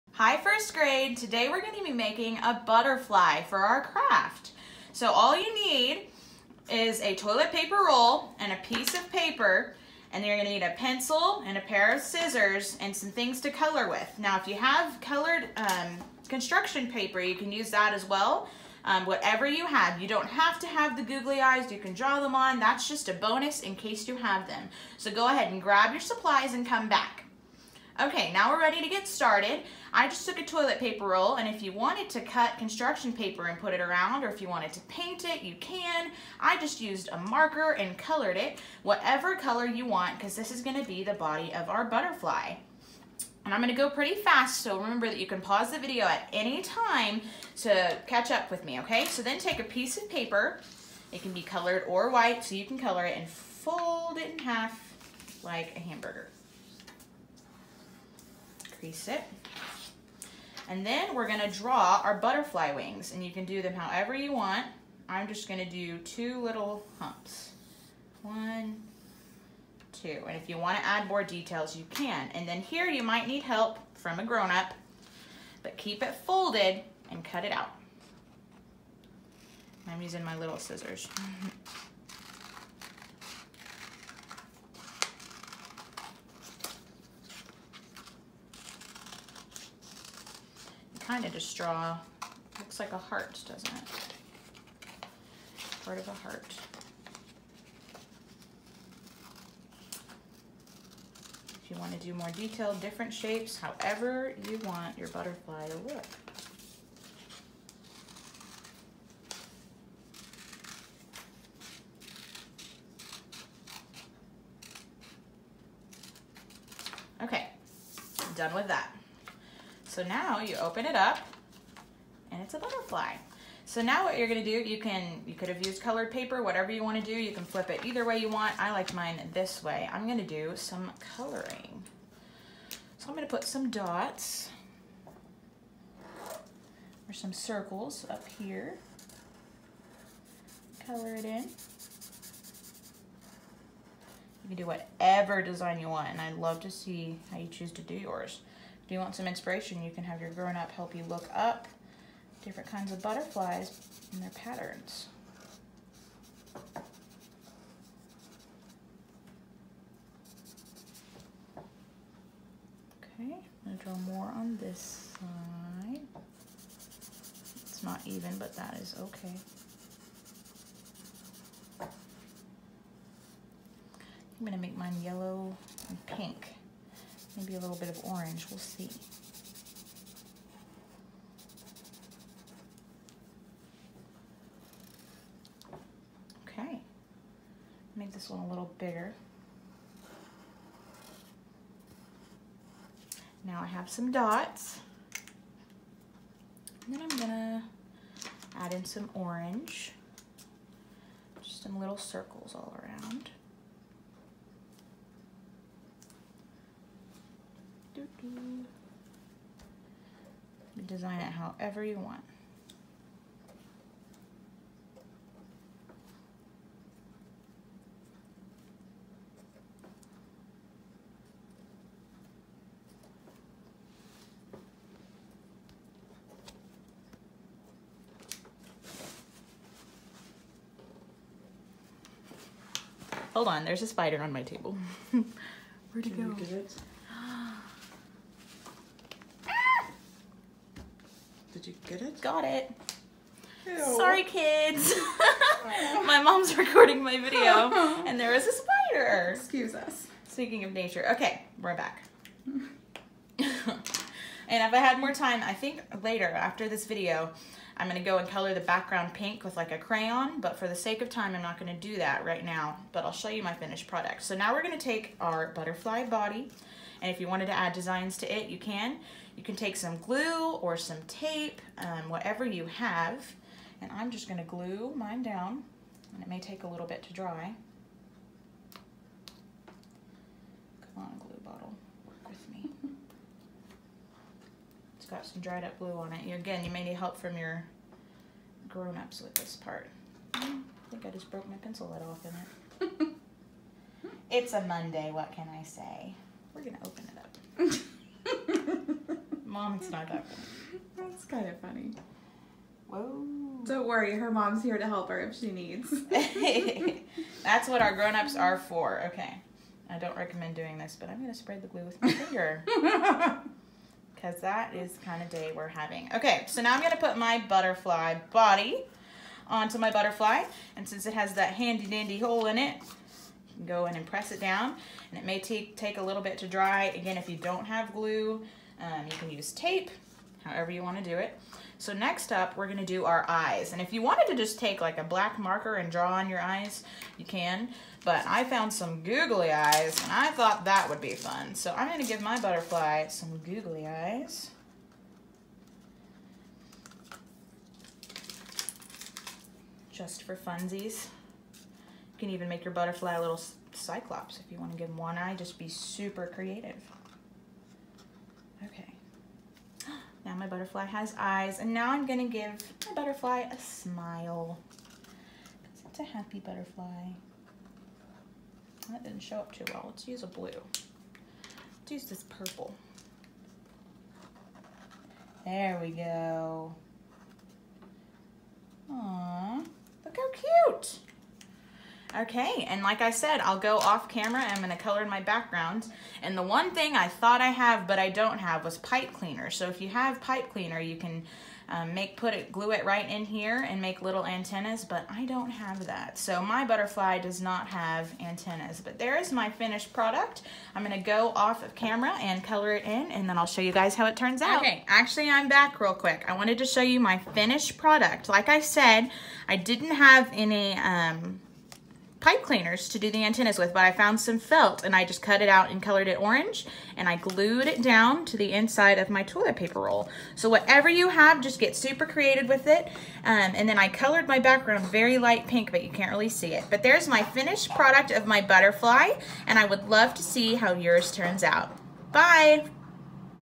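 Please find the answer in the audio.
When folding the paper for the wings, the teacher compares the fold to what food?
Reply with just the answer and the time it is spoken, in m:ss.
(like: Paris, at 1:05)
hamburger, at 0:55.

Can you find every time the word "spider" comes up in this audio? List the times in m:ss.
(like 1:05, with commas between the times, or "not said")
3:53, 4:08.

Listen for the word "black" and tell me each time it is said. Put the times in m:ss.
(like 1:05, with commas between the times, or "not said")
5:35.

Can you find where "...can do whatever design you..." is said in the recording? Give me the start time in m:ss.
2:24.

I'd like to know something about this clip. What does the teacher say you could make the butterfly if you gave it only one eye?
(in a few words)
cyclops.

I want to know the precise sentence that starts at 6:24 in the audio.
I'm gonna color in my background, And the one thing I thought I have, but I don't have, was pipe cleaner.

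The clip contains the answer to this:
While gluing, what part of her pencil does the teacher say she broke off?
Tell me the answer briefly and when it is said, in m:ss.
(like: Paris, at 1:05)
pencil lid, at 4:51.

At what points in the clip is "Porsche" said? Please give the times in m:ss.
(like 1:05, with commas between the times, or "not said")
not said.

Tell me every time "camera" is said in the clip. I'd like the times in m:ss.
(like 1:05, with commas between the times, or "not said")
6:24, 6:41.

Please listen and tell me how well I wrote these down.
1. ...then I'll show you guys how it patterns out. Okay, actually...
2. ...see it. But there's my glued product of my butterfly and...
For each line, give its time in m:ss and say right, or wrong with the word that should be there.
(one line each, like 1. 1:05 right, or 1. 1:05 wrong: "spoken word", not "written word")
1. 6:43 wrong: "turns", not "patterns"
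2. 7:06 wrong: "finished", not "glued".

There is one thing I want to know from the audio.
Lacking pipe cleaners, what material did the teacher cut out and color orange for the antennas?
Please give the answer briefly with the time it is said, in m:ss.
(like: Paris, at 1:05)
felt, at 6:54.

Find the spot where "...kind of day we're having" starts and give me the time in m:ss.
5:15.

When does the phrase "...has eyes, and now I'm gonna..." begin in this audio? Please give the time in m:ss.
6:00.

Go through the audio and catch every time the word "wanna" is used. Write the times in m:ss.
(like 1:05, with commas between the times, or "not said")
1:10, 2:06, 5:30, 5:54.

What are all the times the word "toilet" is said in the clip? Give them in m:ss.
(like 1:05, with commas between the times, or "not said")
0:07, 0:30, 6:59.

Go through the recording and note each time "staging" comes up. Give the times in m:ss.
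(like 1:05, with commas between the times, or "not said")
not said.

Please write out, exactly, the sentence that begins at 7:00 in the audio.
So whatever you have, just get super creative with it.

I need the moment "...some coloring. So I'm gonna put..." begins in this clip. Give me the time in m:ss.
2:10.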